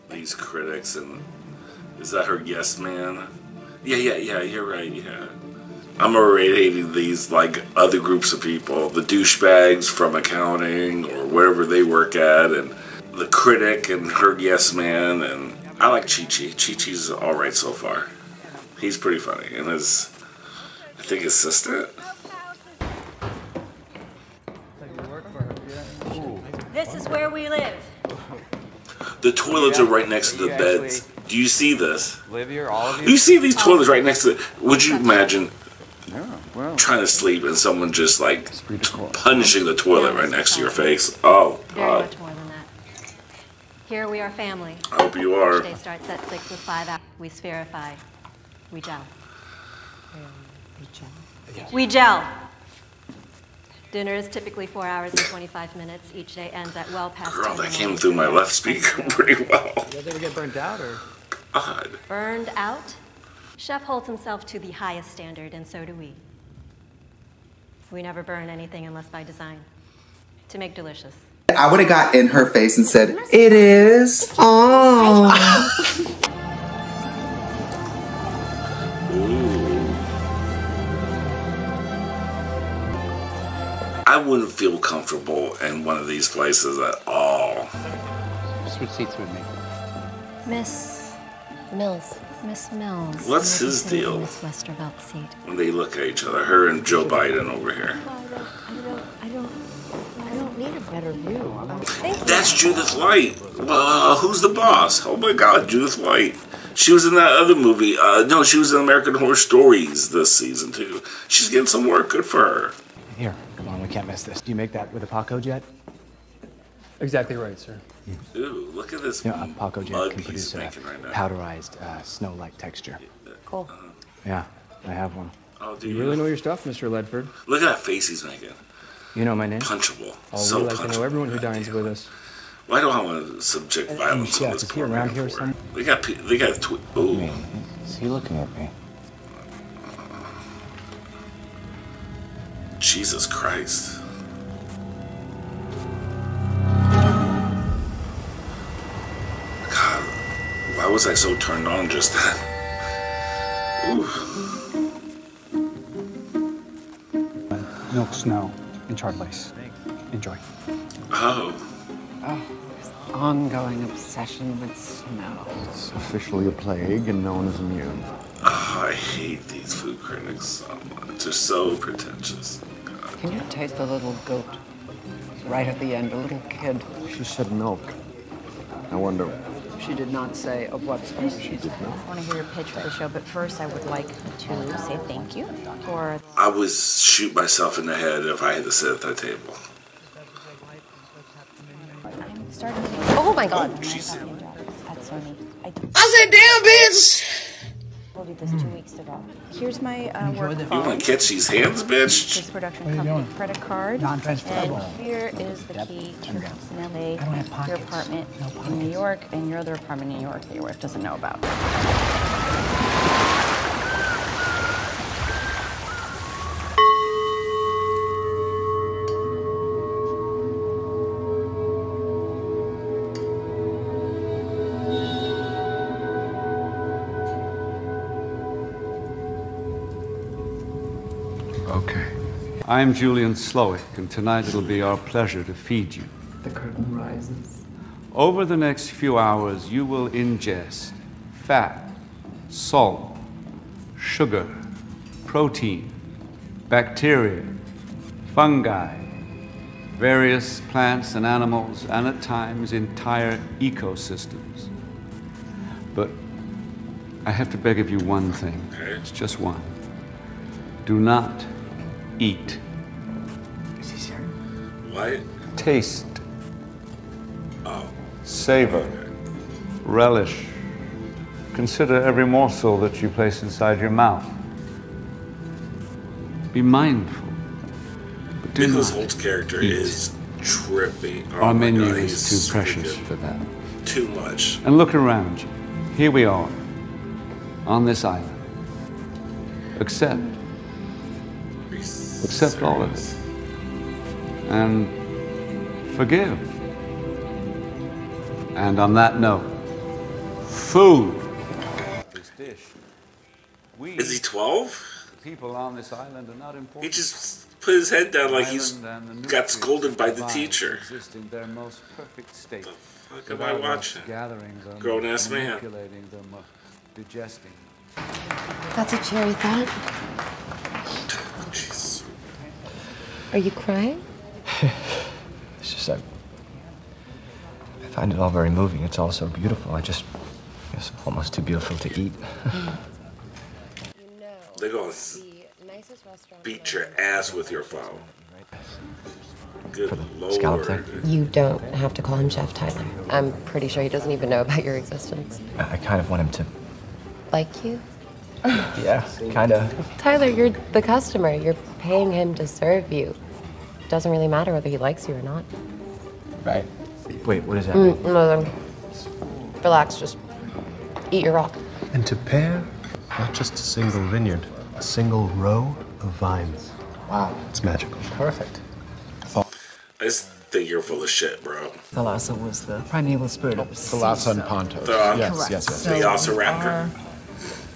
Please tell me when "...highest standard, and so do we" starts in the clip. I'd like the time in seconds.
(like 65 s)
64 s.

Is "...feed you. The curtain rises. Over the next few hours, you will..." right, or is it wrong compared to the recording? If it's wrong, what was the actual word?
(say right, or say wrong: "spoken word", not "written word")
right.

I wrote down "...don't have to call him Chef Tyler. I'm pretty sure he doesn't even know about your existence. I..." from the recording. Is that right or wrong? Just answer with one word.
right.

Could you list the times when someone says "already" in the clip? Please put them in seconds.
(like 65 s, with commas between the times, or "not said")
6 s.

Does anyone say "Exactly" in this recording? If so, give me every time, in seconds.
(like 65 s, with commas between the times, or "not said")
117 s.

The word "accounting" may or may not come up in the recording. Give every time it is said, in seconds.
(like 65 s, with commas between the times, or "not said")
10 s.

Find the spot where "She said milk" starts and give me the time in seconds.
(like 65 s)
177 s.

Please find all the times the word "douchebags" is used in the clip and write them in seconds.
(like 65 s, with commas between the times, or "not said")
9 s.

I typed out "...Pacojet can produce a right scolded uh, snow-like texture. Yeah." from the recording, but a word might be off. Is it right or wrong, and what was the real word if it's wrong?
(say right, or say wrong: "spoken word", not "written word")
wrong: "powderized", not "scolded".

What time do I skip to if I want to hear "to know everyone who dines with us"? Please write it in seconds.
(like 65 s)
130 s.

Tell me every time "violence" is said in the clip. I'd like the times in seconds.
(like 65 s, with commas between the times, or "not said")
133 s.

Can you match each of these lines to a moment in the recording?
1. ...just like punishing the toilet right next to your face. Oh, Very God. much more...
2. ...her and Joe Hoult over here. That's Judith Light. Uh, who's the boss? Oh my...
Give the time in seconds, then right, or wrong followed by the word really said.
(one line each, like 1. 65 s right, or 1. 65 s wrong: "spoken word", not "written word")
1. 37 s right
2. 96 s wrong: "Biden", not "Hoult".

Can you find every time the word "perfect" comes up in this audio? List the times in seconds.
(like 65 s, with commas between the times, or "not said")
311 s, 368 s.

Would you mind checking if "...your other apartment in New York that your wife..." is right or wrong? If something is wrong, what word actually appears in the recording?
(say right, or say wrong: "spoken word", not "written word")
right.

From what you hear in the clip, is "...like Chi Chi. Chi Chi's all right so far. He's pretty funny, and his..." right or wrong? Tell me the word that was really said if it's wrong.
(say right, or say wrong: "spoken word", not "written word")
right.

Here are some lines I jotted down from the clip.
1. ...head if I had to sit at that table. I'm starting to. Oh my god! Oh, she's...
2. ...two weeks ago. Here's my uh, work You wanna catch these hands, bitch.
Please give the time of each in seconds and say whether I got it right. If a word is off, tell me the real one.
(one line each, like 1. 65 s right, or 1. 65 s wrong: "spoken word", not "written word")
1. 187 s right
2. 198 s right.